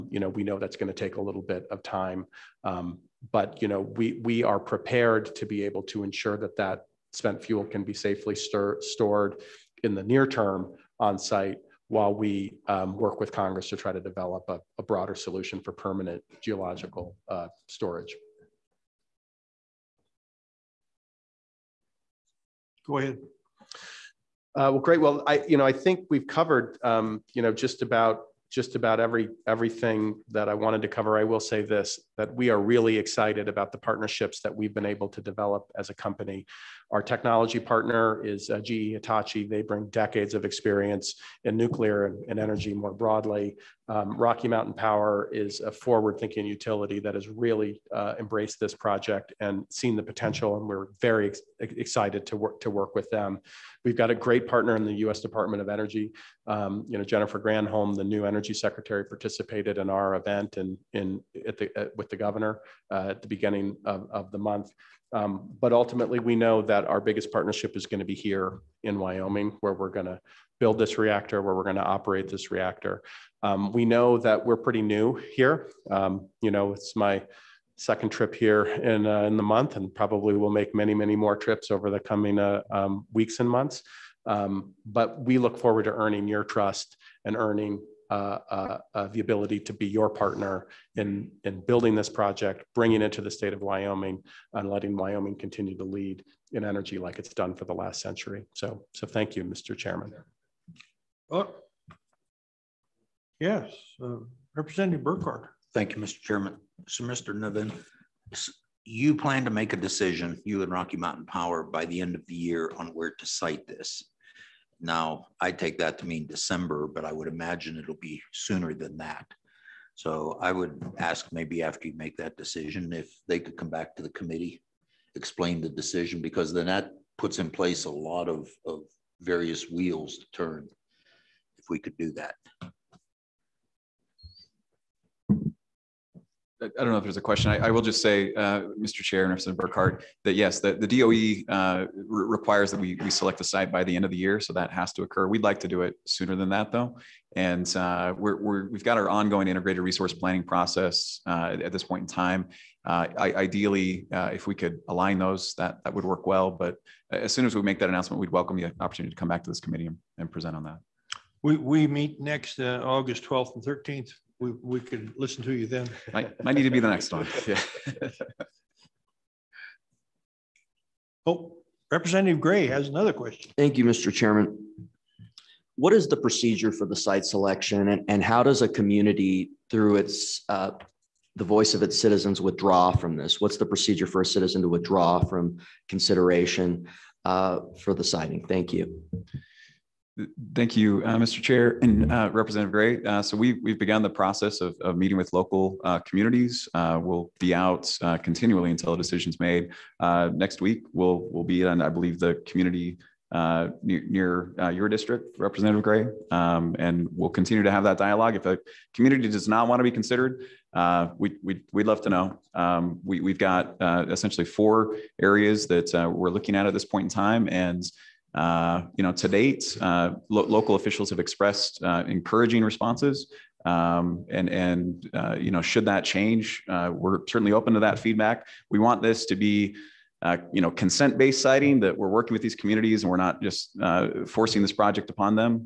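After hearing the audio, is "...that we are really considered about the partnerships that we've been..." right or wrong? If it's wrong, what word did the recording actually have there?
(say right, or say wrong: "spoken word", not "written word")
wrong: "excited", not "considered".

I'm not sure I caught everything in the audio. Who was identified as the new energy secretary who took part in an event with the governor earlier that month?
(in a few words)
Jennifer Granholm.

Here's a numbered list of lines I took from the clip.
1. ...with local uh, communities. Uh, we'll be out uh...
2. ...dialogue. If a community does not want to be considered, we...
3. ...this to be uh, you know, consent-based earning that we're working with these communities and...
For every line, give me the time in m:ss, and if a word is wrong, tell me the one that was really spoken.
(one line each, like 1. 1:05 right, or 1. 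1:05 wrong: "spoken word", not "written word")
1. 3:15 right
2. 3:27 right
3. 3:49 wrong: "siting", not "earning".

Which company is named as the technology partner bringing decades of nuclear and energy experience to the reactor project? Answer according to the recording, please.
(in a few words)
GE Hitachi.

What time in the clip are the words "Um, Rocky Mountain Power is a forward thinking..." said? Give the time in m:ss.
0:43.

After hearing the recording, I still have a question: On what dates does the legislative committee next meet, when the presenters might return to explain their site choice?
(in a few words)
August 12th and 13th.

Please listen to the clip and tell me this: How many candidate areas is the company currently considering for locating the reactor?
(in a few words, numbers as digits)
4.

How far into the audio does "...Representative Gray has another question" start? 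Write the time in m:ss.
2:51.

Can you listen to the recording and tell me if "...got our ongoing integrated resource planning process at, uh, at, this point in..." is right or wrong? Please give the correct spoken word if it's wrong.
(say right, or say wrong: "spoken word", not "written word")
right.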